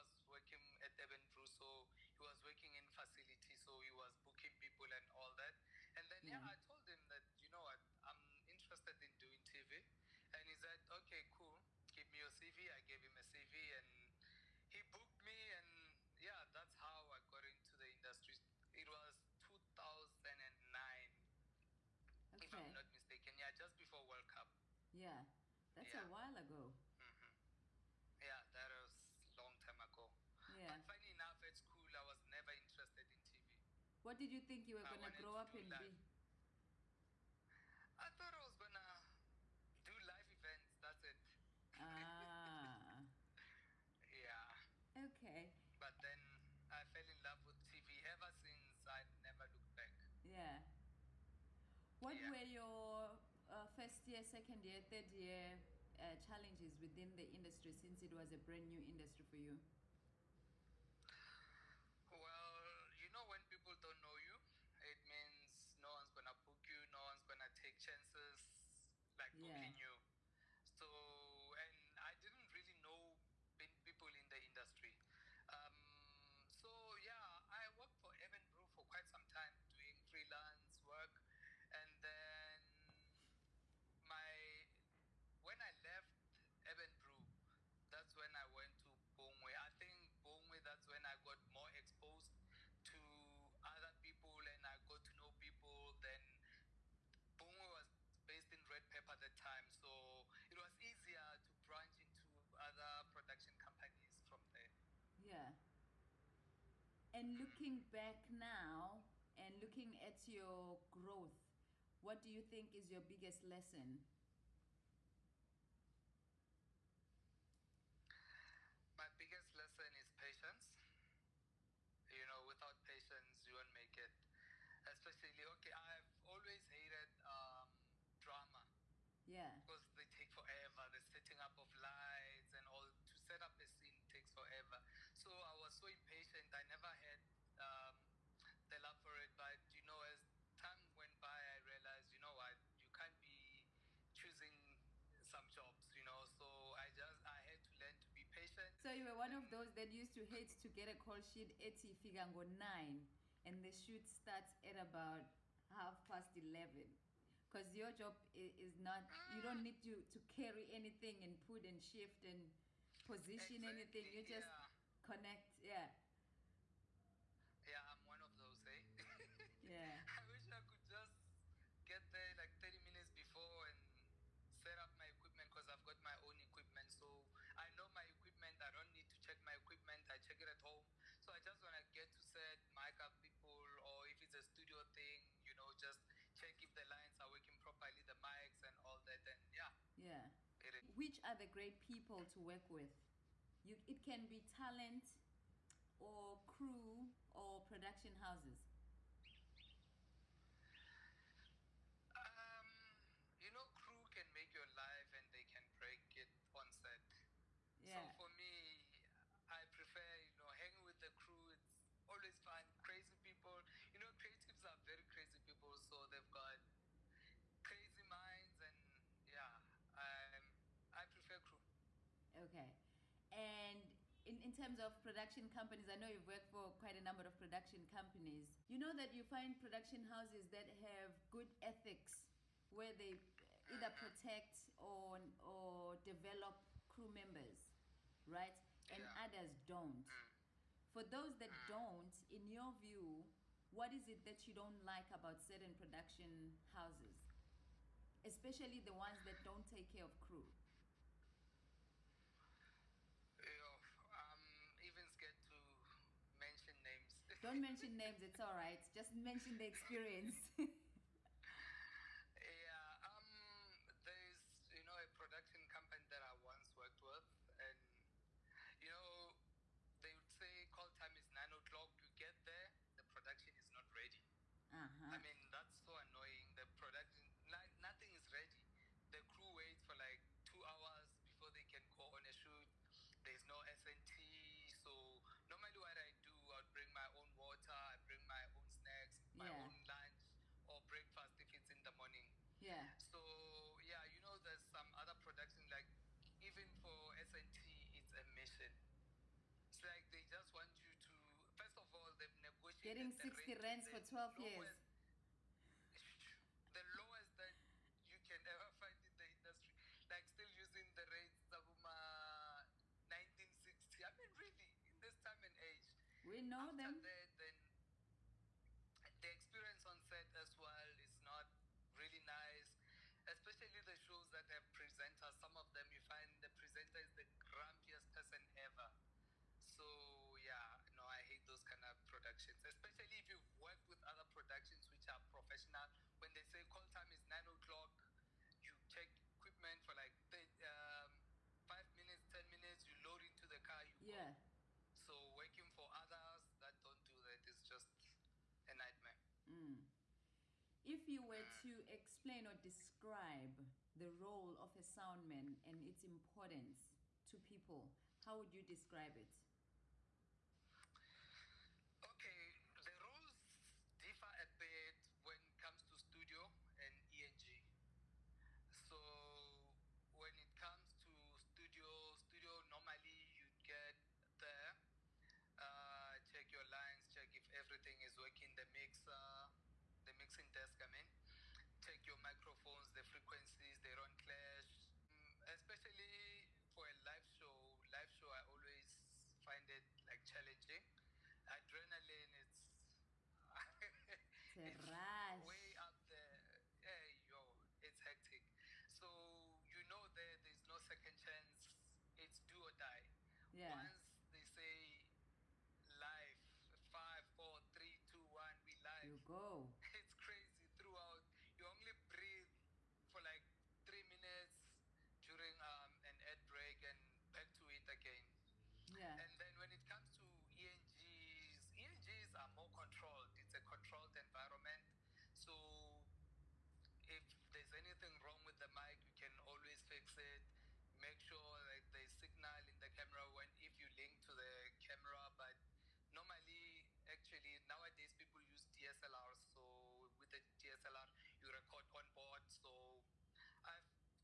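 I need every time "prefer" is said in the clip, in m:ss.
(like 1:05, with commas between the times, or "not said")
3:29, 3:41.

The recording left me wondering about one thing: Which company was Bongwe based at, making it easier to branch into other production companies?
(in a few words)
Red Pepper.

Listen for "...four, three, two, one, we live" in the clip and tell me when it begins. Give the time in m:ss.
6:47.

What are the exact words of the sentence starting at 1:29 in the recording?
I think Bongwe that's when I got more exposed to other people and I got to know people.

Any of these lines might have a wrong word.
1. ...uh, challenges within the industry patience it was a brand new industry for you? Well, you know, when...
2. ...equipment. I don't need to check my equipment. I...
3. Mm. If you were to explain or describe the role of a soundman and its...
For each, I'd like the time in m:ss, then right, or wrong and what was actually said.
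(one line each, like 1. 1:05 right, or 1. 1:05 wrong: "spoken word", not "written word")
1. 0:55 wrong: "since", not "patience"
2. 2:58 right
3. 5:49 right.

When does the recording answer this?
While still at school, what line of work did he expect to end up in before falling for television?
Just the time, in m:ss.
0:40.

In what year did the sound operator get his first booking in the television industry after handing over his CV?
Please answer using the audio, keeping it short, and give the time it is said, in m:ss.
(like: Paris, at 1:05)
2009, at 0:19.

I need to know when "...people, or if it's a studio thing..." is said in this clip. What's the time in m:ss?
3:03.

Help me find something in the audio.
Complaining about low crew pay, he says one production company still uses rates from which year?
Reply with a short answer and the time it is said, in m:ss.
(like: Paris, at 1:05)
1960, at 5:11.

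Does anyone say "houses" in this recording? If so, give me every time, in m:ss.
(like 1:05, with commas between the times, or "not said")
3:18, 3:50, 4:06.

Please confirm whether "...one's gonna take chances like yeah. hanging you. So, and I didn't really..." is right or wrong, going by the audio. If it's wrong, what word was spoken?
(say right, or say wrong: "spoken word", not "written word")
wrong: "booking", not "hanging".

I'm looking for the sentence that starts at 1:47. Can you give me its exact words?
And looking back now and looking at your growth, what do you think is your biggest lesson?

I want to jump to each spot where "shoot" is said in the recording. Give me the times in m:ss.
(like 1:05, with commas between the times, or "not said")
2:33, 4:42.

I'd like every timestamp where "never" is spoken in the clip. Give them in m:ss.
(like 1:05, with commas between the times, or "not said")
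0:32, 0:49, 2:16.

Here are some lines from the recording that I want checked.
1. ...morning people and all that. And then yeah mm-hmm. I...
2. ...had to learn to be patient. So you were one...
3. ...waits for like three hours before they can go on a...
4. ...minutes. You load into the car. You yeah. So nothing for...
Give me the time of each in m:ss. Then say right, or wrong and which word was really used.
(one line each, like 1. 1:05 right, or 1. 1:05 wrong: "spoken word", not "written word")
1. 0:04 wrong: "booking", not "morning"
2. 2:27 right
3. 4:39 wrong: "two", not "three"
4. 5:42 wrong: "working", not "nothing".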